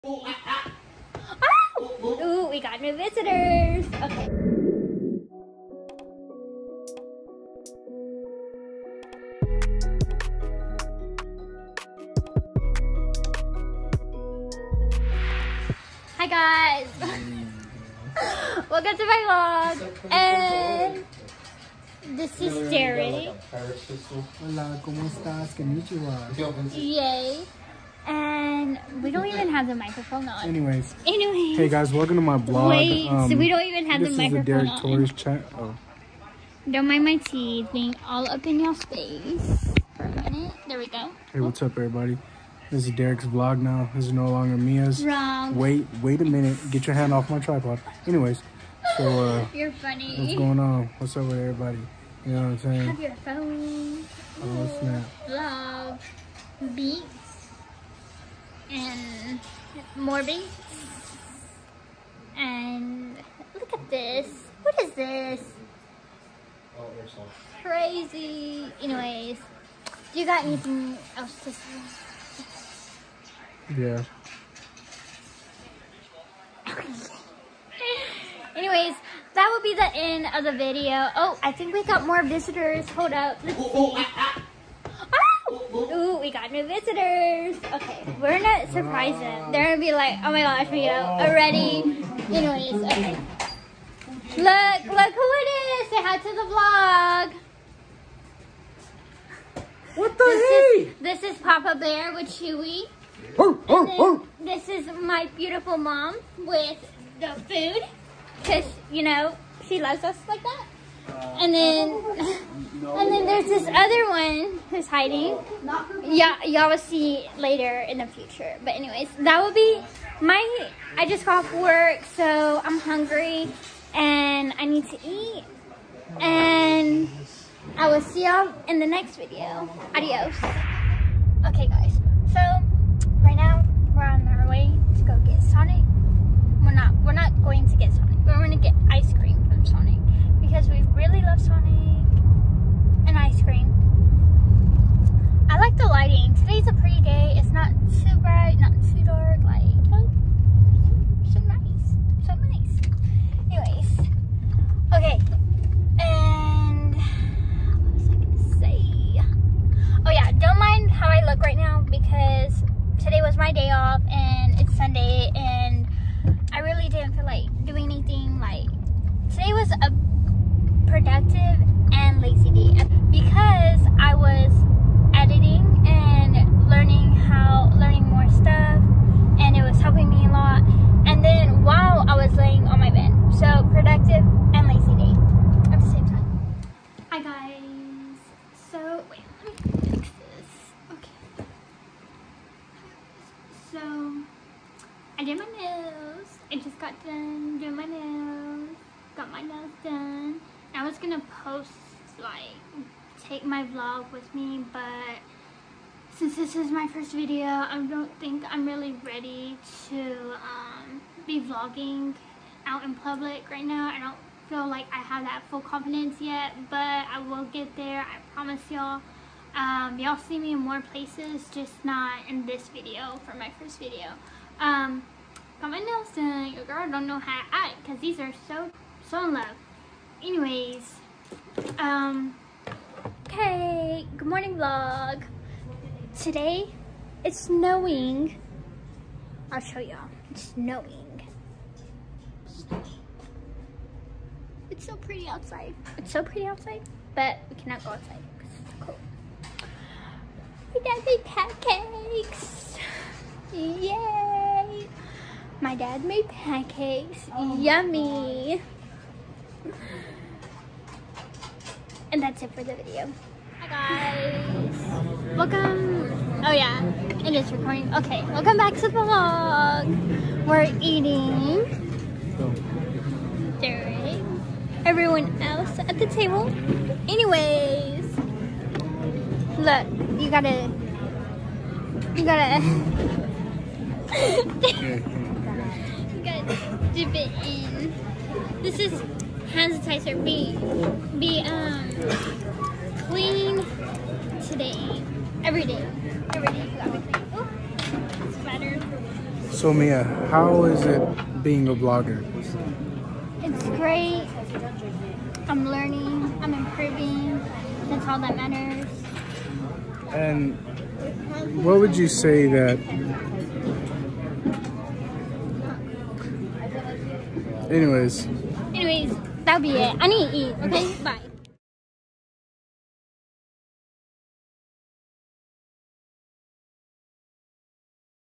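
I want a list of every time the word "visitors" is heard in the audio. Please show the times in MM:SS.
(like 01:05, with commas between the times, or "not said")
00:02, 01:22, 01:26.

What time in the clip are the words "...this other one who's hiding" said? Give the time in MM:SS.
01:53.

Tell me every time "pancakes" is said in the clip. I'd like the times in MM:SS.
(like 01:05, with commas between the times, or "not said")
04:11, 04:16.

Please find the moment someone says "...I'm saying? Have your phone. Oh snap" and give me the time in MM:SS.
00:52.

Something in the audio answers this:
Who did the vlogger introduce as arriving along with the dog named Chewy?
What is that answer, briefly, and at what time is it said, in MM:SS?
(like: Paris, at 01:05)
Papa Bear, at 01:41.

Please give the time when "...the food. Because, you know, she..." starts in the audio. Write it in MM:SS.
01:47.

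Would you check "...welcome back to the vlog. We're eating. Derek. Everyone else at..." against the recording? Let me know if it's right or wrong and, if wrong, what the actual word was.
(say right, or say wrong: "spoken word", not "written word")
right.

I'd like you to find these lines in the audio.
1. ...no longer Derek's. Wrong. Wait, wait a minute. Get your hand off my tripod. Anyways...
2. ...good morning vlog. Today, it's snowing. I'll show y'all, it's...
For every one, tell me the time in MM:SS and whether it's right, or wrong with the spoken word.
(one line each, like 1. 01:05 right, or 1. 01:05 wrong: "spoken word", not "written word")
1. 00:44 wrong: "Mia", not "Derek"
2. 03:54 right.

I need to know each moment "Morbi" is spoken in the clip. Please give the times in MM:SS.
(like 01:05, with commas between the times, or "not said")
00:59.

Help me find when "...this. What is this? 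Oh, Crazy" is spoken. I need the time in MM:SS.
01:03.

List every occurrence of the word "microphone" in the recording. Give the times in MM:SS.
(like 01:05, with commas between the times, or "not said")
00:29, 00:34.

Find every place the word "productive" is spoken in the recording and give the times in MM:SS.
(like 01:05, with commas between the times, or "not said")
02:50, 03:03.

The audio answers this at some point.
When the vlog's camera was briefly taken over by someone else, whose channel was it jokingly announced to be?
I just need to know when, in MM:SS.
00:34.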